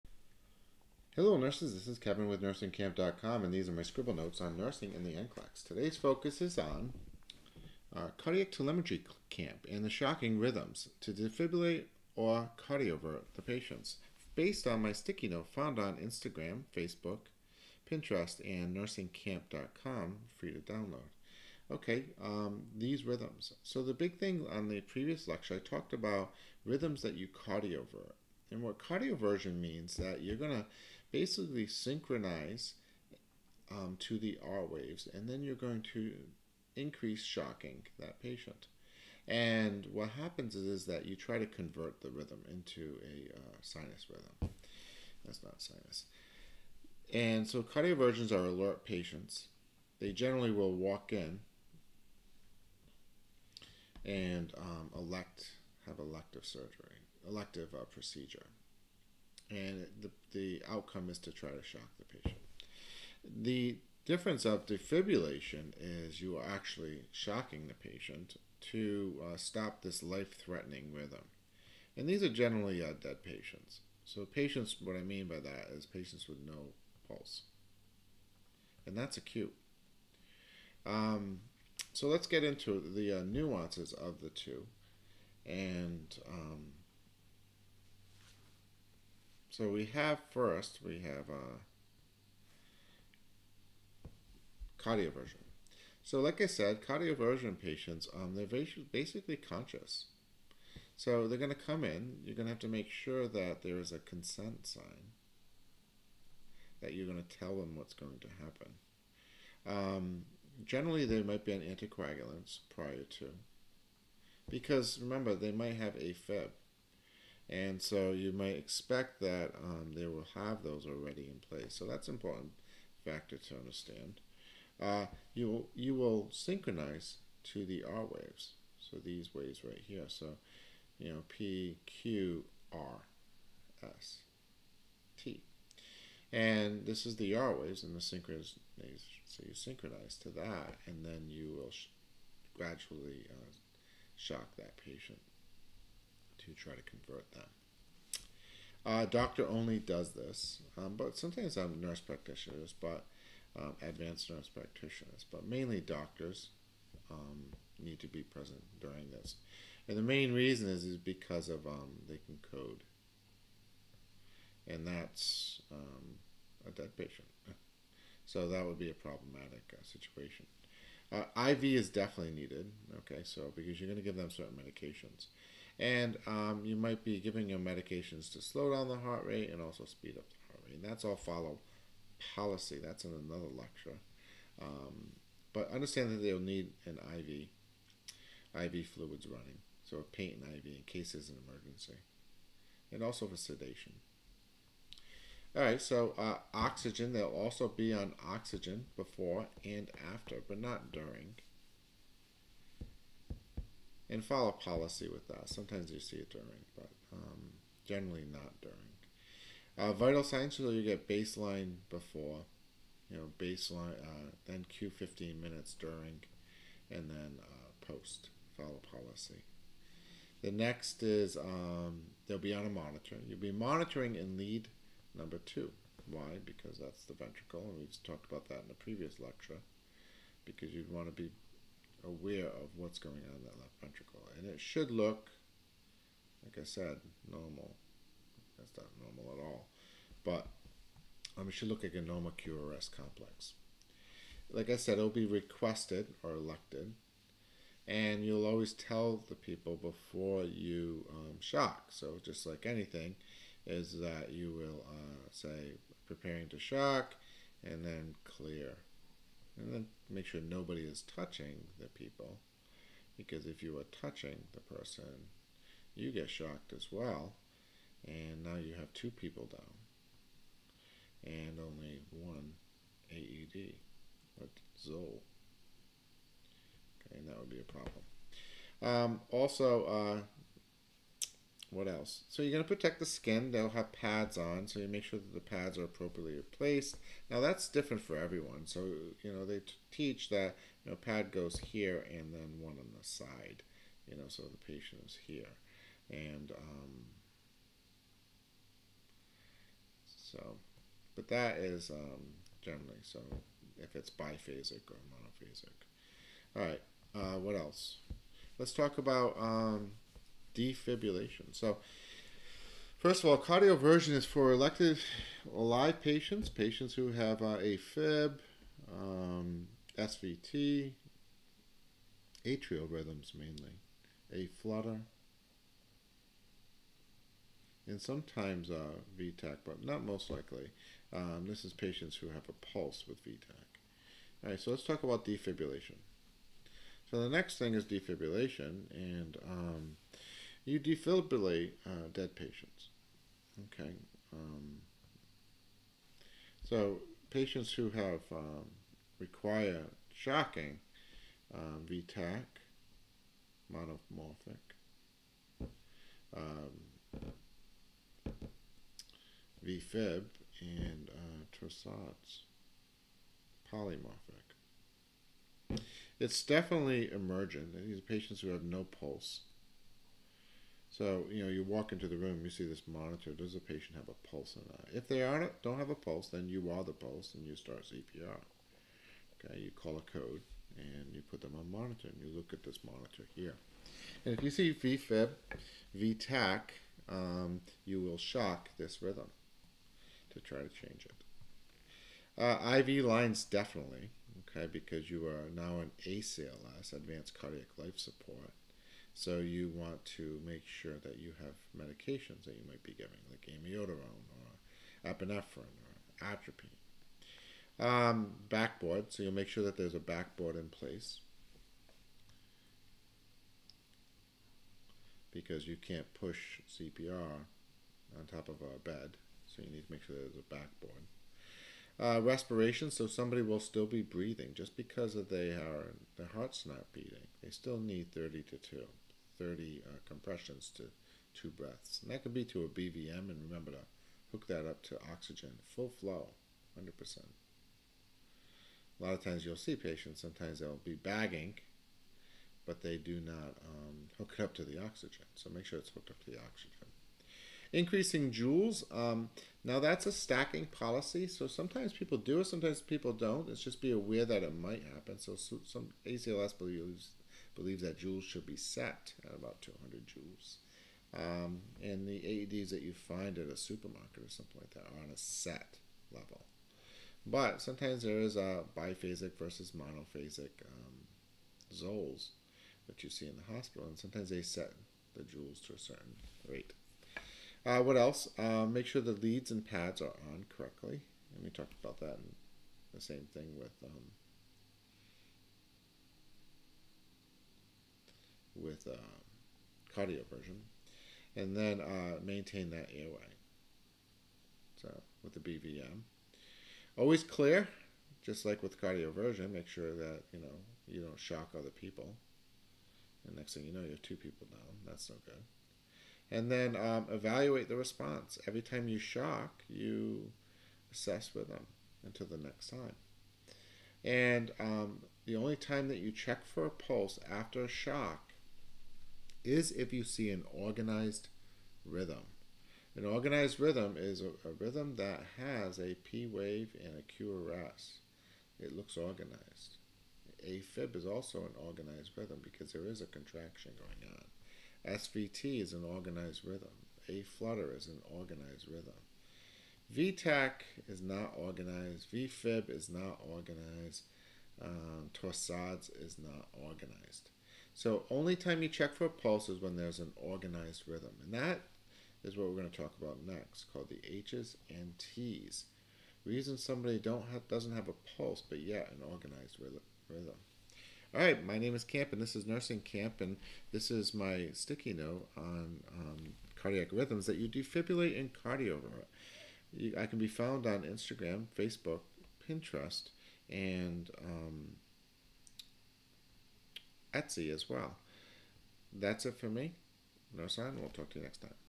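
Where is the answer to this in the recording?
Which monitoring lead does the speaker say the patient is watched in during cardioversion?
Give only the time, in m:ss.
3:44.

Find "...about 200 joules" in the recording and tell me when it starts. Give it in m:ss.
7:39.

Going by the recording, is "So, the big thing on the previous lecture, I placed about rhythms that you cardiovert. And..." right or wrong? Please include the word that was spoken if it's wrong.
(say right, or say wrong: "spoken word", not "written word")
wrong: "talked", not "placed".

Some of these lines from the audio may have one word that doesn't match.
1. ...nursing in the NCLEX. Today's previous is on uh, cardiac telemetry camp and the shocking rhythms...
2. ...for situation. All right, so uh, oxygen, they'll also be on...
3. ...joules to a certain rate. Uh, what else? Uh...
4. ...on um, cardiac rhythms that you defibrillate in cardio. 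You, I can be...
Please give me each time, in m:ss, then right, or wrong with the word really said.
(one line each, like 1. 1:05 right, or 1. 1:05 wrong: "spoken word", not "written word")
1. 0:04 wrong: "focus", not "previous"
2. 3:13 wrong: "sedation", not "situation"
3. 7:55 right
4. 9:25 right.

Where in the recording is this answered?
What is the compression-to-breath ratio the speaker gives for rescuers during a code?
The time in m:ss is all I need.
7:08.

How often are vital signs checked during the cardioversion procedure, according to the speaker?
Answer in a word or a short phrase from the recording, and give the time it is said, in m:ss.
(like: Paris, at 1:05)
Q 15 minutes, at 3:34.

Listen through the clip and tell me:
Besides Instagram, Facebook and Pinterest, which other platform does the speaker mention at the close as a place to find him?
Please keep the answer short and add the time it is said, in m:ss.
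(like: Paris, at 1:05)
Etsy, at 9:37.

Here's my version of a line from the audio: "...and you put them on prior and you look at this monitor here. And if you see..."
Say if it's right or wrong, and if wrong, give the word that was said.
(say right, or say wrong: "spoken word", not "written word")
wrong: "monitor", not "prior".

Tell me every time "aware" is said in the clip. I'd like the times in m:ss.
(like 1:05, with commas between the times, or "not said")
3:52, 7:33.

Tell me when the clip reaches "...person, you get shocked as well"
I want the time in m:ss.
4:24.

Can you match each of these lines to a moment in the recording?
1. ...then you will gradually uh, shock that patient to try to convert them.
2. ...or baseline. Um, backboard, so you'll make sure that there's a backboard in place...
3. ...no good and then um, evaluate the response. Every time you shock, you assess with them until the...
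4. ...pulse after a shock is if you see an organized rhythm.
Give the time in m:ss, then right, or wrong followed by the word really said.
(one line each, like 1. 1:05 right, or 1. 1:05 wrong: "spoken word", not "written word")
1. 2:21 right
2. 6:45 wrong: "atropine", not "baseline"
3. 8:25 right
4. 8:36 right.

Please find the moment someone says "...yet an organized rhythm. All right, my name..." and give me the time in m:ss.
9:18.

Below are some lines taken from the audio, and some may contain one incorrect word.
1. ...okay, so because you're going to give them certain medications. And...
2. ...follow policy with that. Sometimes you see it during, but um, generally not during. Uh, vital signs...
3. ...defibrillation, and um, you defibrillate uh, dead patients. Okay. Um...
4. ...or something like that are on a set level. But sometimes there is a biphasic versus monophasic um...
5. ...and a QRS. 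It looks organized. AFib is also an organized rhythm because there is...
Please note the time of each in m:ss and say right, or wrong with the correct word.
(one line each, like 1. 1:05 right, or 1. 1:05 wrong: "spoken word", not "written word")
1. 2:52 right
2. 3:24 right
3. 5:37 right
4. 7:44 right
5. 8:46 right.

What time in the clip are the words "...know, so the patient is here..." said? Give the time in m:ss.
4:54.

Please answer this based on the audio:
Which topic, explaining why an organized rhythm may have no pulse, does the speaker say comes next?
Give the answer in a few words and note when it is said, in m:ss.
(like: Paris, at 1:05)
H's and T's, at 9:14.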